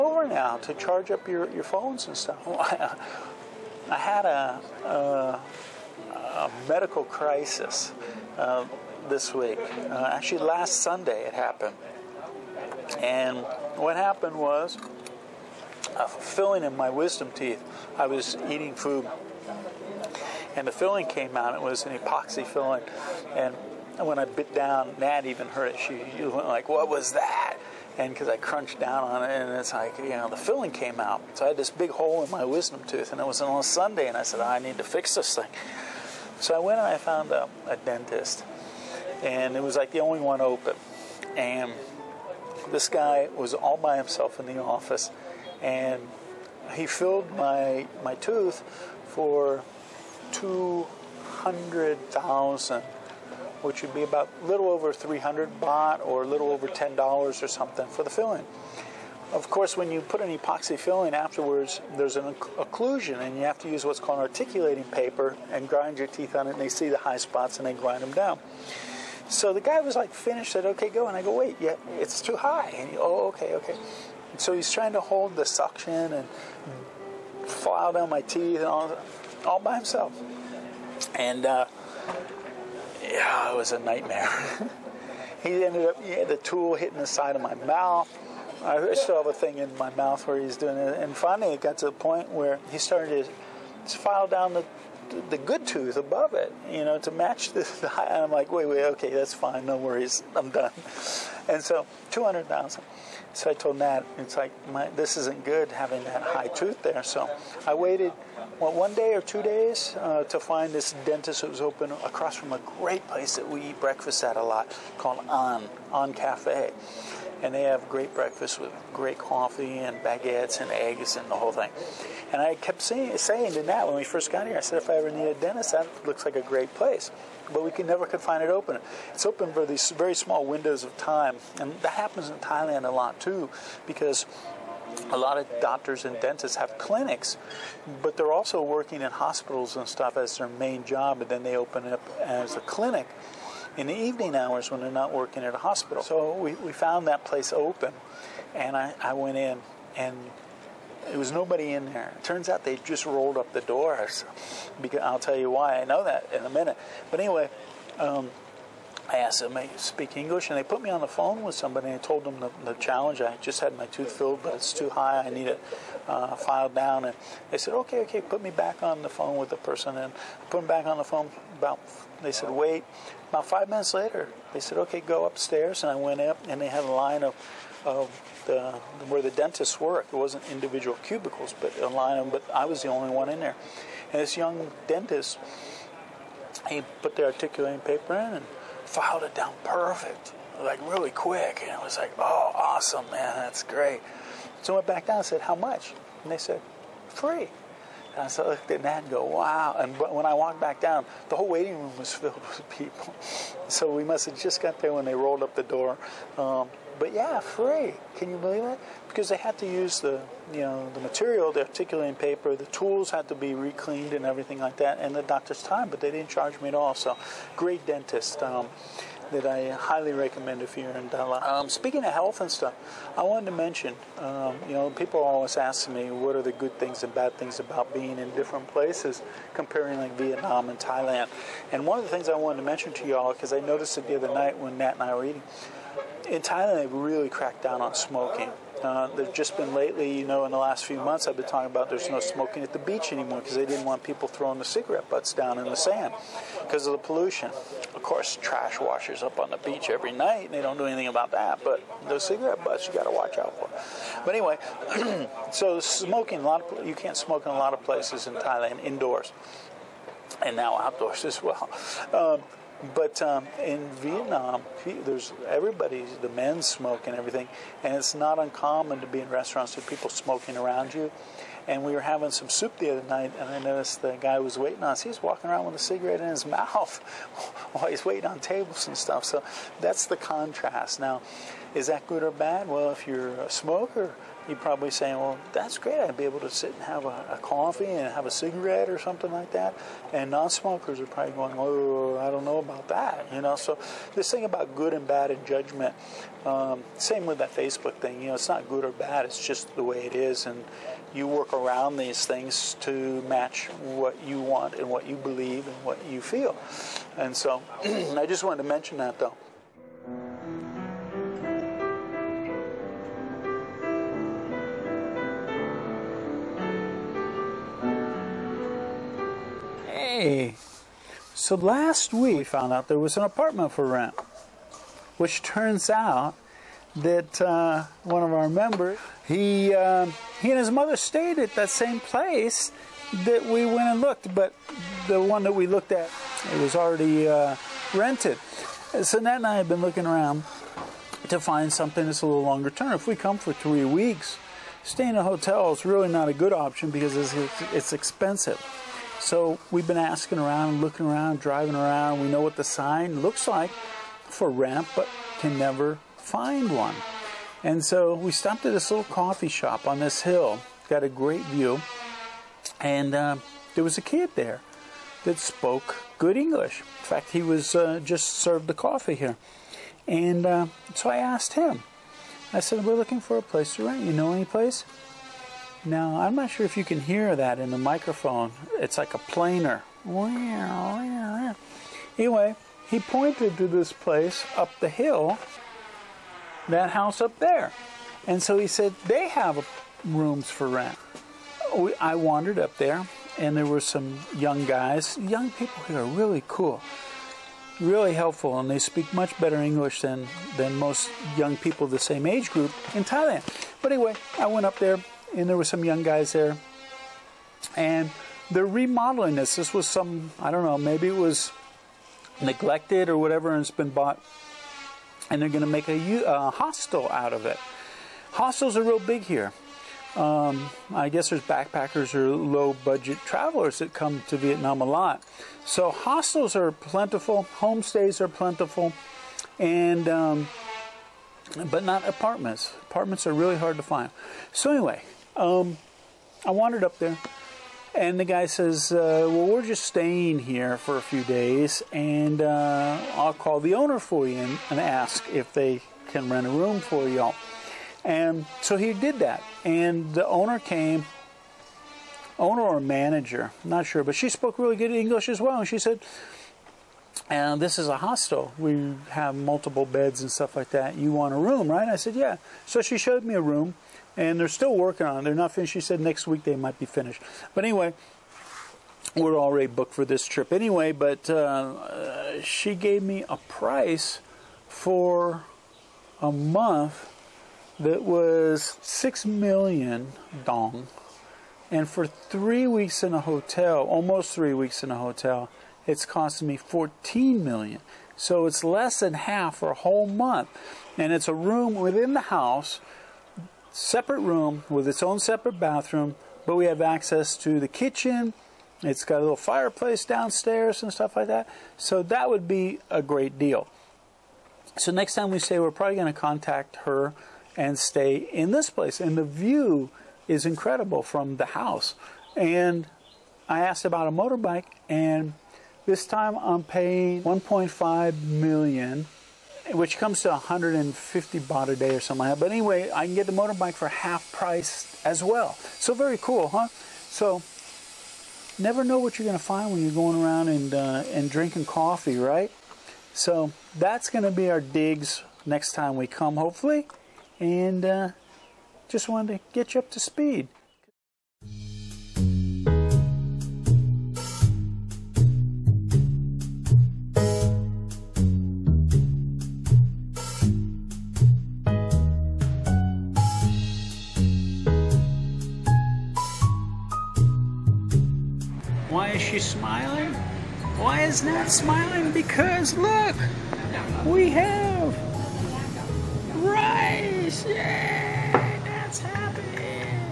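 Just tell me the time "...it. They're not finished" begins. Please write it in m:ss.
7:45.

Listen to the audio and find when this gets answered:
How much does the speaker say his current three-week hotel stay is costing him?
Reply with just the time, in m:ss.
8:06.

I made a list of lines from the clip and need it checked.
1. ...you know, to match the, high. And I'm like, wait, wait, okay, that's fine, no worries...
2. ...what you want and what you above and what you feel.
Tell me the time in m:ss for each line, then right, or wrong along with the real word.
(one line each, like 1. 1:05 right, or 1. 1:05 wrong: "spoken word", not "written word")
1. 1:36 right
2. 5:03 wrong: "believe", not "above".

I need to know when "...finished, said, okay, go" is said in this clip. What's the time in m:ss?
1:10.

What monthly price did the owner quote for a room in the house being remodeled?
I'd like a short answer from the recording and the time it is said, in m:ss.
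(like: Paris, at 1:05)
6 million dong, at 7:58.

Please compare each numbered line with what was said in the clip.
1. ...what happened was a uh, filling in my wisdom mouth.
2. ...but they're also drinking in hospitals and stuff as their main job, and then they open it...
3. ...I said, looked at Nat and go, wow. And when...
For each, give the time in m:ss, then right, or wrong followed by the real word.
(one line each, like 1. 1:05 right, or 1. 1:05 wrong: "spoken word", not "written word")
1. 0:13 wrong: "teeth", not "mouth"
2. 2:18 wrong: "working", not "drinking"
3. 3:18 right.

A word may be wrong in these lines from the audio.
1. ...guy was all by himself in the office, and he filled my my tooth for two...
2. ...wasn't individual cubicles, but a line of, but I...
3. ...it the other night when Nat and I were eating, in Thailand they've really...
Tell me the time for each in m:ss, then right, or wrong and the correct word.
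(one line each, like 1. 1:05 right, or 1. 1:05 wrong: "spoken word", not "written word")
1. 0:42 right
2. 3:00 right
3. 3:53 right.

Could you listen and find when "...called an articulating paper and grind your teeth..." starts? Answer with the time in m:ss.
1:03.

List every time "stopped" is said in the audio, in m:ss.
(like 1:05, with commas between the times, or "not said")
5:58.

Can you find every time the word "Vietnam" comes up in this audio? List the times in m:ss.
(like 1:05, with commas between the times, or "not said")
3:50, 4:23, 7:04.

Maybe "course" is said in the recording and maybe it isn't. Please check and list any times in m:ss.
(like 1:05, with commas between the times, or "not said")
0:59, 4:08.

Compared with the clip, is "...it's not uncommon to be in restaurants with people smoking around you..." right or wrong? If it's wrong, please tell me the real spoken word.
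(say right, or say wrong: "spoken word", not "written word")
right.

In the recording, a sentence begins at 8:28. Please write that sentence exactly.
And the view is incredible from the house.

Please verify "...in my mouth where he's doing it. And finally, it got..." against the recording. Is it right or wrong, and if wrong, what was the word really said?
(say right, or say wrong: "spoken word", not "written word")
right.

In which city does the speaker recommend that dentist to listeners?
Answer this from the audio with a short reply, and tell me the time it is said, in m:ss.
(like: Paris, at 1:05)
Dalat, at 3:41.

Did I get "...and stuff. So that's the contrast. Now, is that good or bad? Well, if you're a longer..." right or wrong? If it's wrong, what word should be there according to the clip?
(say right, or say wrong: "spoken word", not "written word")
wrong: "smoker", not "longer".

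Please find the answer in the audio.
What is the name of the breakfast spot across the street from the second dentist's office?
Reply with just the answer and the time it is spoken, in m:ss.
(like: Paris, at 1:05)
An On Cafe, at 1:55.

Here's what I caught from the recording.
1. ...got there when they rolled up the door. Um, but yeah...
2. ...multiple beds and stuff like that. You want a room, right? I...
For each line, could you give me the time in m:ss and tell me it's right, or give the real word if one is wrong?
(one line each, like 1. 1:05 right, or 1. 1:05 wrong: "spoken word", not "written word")
1. 3:24 right
2. 7:39 right.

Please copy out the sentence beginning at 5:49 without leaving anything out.
So we've been asking around, looking around, driving around.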